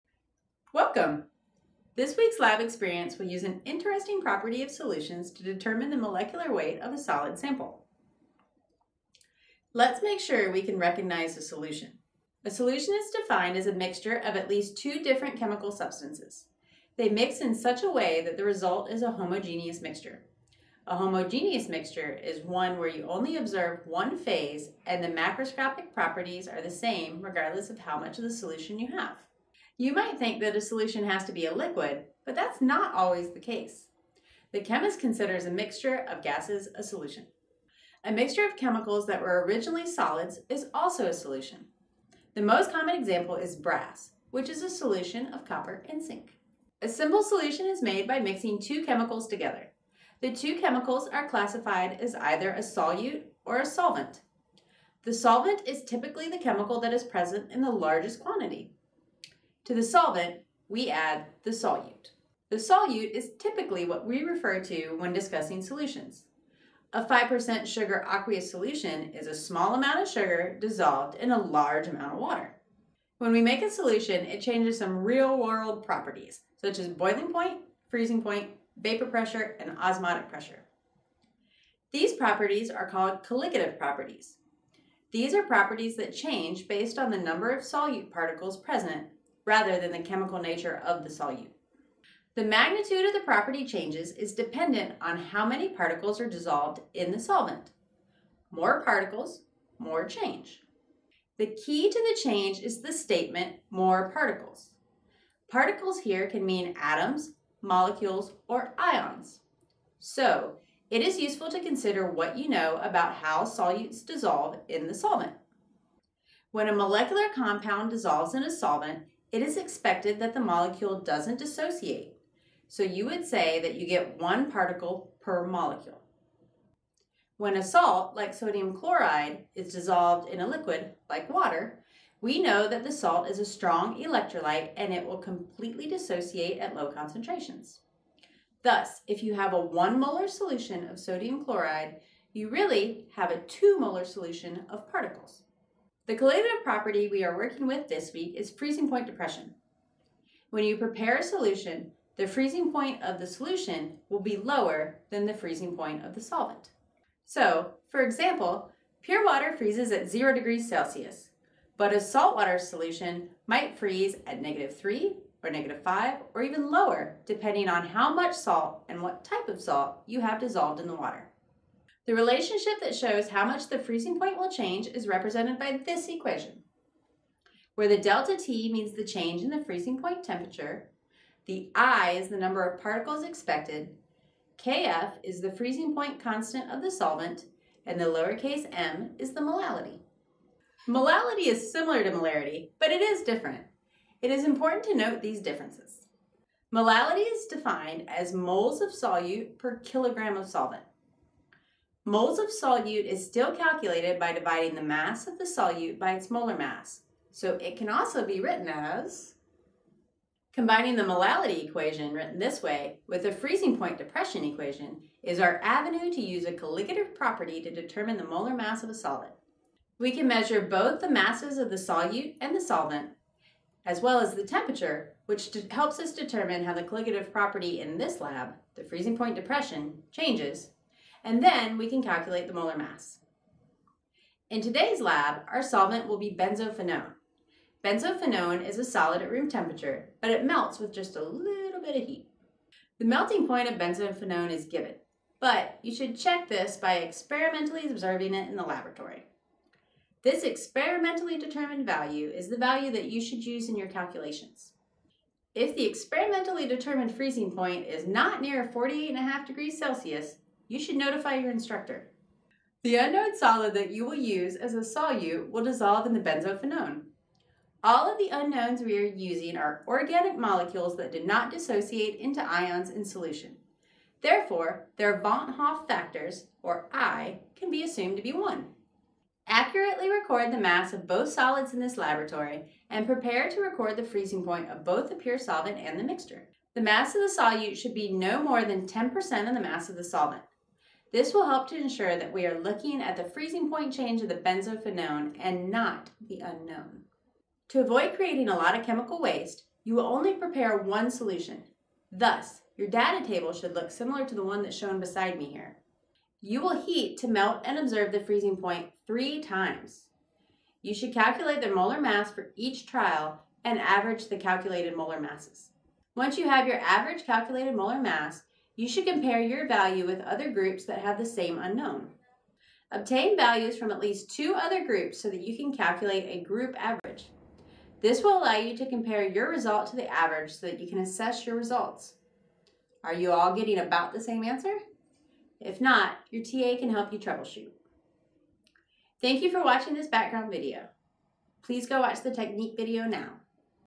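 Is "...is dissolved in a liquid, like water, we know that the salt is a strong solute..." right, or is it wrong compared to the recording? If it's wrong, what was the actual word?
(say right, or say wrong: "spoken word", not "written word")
wrong: "electrolyte", not "solute".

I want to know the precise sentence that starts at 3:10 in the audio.
Molality is similar to molarity, but it is different.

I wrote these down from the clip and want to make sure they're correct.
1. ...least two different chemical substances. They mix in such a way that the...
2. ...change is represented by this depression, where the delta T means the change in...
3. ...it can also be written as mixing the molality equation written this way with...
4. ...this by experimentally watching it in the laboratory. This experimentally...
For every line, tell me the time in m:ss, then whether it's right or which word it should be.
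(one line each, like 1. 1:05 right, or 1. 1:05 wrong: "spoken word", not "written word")
1. 0:14 right
2. 2:54 wrong: "equation", not "depression"
3. 3:27 wrong: "combining", not "mixing"
4. 4:06 wrong: "observing", not "watching".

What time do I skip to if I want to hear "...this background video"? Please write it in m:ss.
5:39.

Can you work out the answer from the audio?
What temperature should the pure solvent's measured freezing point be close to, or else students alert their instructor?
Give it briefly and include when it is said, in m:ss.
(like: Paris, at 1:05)
48.5 degrees Celsius, at 4:18.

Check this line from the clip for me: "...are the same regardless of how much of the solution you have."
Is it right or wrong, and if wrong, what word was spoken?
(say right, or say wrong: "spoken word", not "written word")
right.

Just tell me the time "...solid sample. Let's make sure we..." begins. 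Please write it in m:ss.
0:06.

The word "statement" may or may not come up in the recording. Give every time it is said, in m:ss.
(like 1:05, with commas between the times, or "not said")
1:42.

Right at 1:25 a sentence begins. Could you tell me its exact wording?
These are properties that change based on the number of solute particles present rather than the chemical nature of the solute.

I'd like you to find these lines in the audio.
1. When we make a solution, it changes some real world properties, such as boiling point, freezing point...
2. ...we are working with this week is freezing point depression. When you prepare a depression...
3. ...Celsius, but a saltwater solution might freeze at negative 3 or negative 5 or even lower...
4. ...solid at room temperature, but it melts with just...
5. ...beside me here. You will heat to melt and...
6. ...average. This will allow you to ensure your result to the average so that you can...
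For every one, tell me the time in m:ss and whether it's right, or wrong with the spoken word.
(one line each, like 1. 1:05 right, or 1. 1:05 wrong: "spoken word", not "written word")
1. 1:13 right
2. 2:27 wrong: "solution", not "depression"
3. 2:40 right
4. 3:58 right
5. 5:05 right
6. 5:26 wrong: "compare", not "ensure".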